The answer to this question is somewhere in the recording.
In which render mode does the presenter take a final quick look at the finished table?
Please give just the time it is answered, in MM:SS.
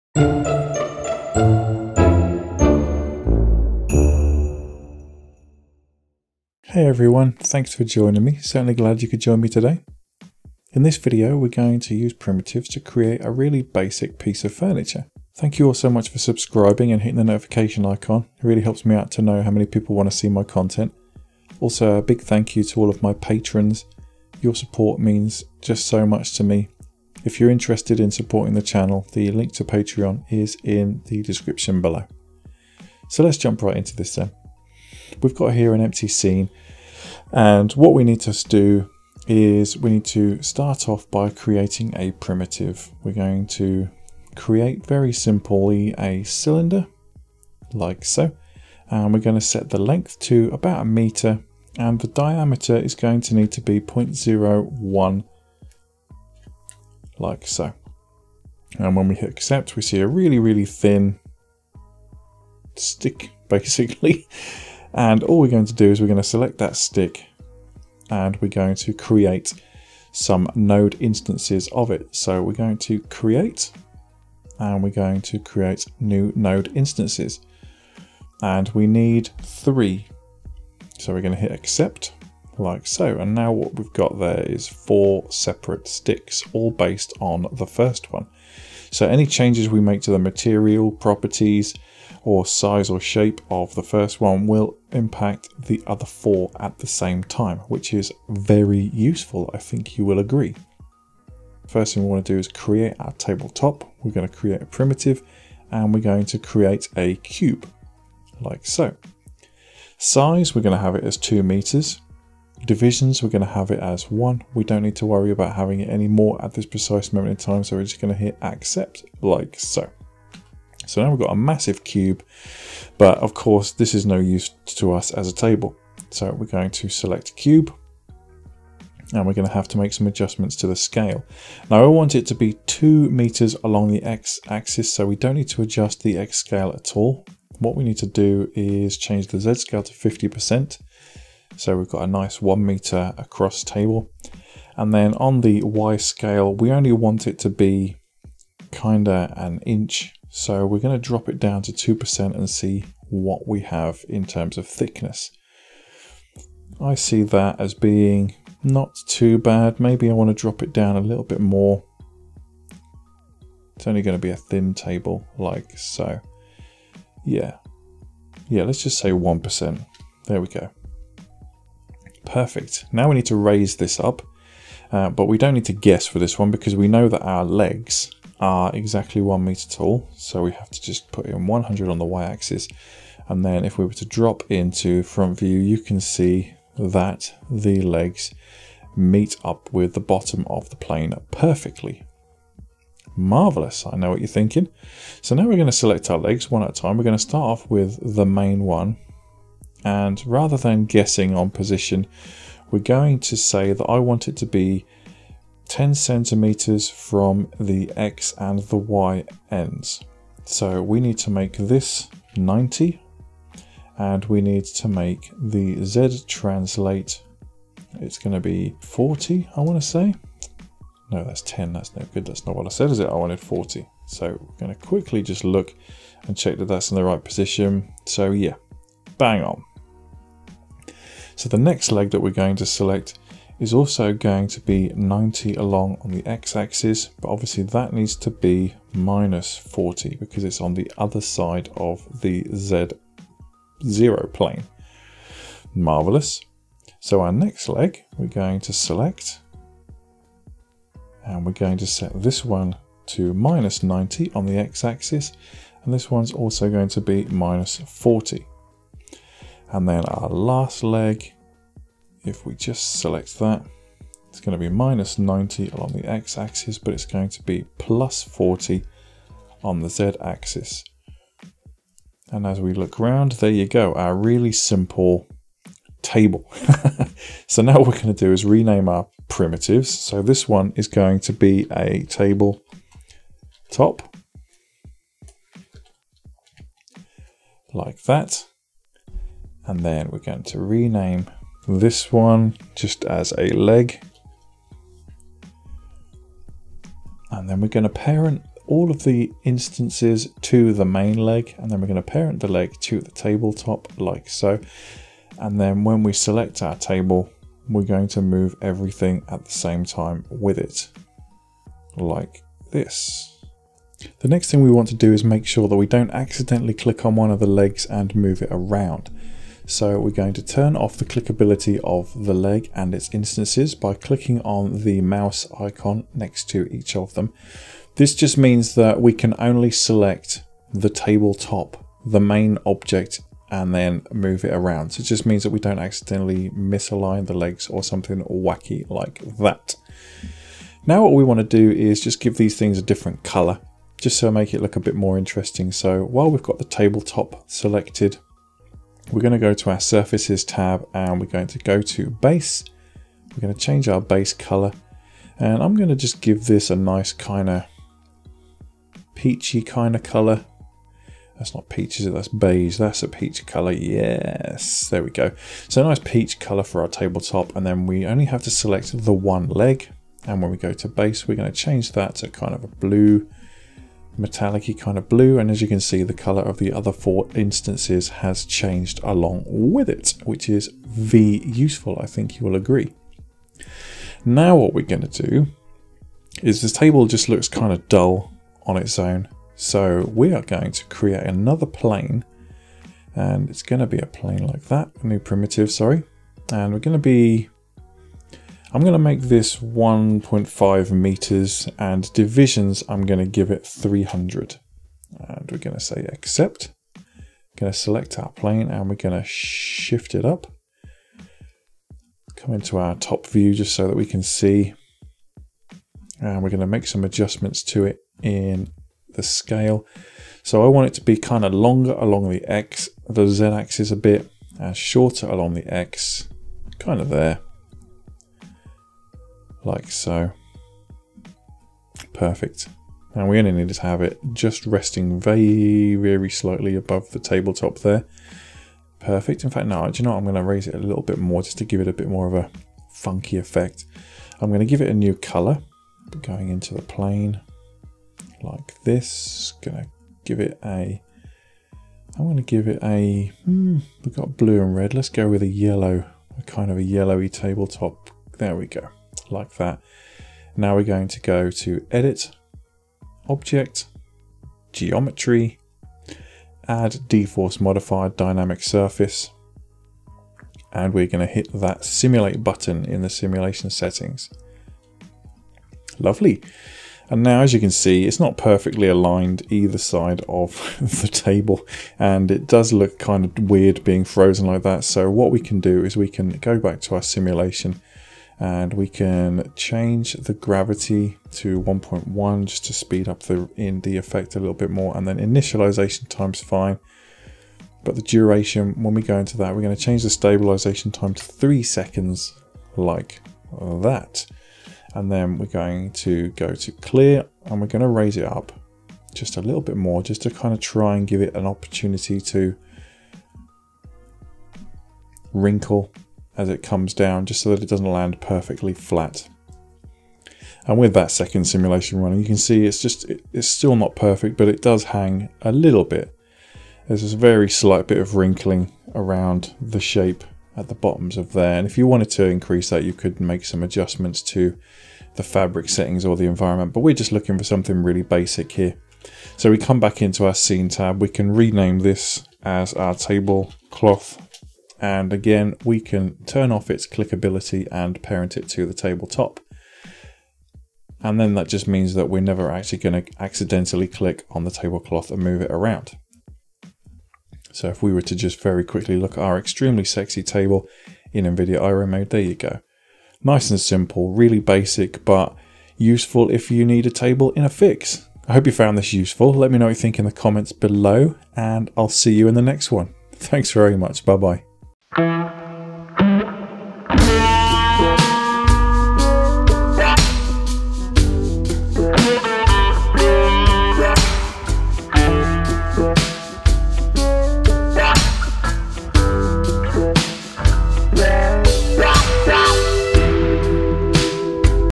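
09:21.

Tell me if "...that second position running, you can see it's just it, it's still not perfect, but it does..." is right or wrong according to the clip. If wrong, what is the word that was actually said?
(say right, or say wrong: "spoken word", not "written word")
wrong: "simulation", not "position".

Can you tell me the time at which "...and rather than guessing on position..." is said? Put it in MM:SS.
03:19.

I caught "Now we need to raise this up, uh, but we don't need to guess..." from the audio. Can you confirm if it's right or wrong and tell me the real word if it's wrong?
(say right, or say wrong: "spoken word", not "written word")
right.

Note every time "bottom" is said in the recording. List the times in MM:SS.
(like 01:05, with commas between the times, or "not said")
03:09, 08:50.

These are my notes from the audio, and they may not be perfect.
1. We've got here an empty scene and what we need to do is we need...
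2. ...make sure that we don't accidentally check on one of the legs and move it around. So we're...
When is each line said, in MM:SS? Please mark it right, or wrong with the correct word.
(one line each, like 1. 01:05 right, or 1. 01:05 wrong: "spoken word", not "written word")
1. 00:35 right
2. 05:15 wrong: "click", not "check".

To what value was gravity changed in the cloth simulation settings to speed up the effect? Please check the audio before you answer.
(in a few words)
1.1.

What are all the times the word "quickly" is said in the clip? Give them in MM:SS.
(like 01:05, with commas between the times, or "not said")
03:44, 09:18.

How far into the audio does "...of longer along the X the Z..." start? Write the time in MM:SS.
07:01.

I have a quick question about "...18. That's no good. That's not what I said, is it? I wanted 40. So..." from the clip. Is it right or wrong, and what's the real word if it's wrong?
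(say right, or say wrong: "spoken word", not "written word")
wrong: "10", not "18".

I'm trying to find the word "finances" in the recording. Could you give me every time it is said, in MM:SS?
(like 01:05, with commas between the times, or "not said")
not said.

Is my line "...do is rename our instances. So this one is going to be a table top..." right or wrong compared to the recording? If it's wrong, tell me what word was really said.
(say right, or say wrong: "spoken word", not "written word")
wrong: "primitives", not "instances".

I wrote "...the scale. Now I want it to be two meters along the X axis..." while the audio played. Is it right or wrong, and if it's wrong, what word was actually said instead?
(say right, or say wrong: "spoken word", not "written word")
right.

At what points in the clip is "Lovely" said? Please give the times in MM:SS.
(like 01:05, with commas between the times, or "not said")
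07:55.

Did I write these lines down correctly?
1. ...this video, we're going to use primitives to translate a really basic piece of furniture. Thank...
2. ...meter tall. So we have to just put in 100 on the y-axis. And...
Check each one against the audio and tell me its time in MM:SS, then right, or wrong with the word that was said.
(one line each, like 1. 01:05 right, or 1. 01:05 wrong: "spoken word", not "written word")
1. 00:10 wrong: "create", not "translate"
2. 02:59 right.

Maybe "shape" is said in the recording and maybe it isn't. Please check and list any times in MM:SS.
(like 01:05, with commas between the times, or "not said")
01:32, 08:49.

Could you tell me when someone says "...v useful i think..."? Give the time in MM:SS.
06:20.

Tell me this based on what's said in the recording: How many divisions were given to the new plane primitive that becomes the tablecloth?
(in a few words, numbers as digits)
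300.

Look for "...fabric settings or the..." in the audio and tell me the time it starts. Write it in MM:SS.
08:55.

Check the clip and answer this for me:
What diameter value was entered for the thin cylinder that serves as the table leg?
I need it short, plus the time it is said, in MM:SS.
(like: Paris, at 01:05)
0.01, at 00:53.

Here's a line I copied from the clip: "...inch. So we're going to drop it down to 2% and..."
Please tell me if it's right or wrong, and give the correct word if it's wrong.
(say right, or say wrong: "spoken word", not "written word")
right.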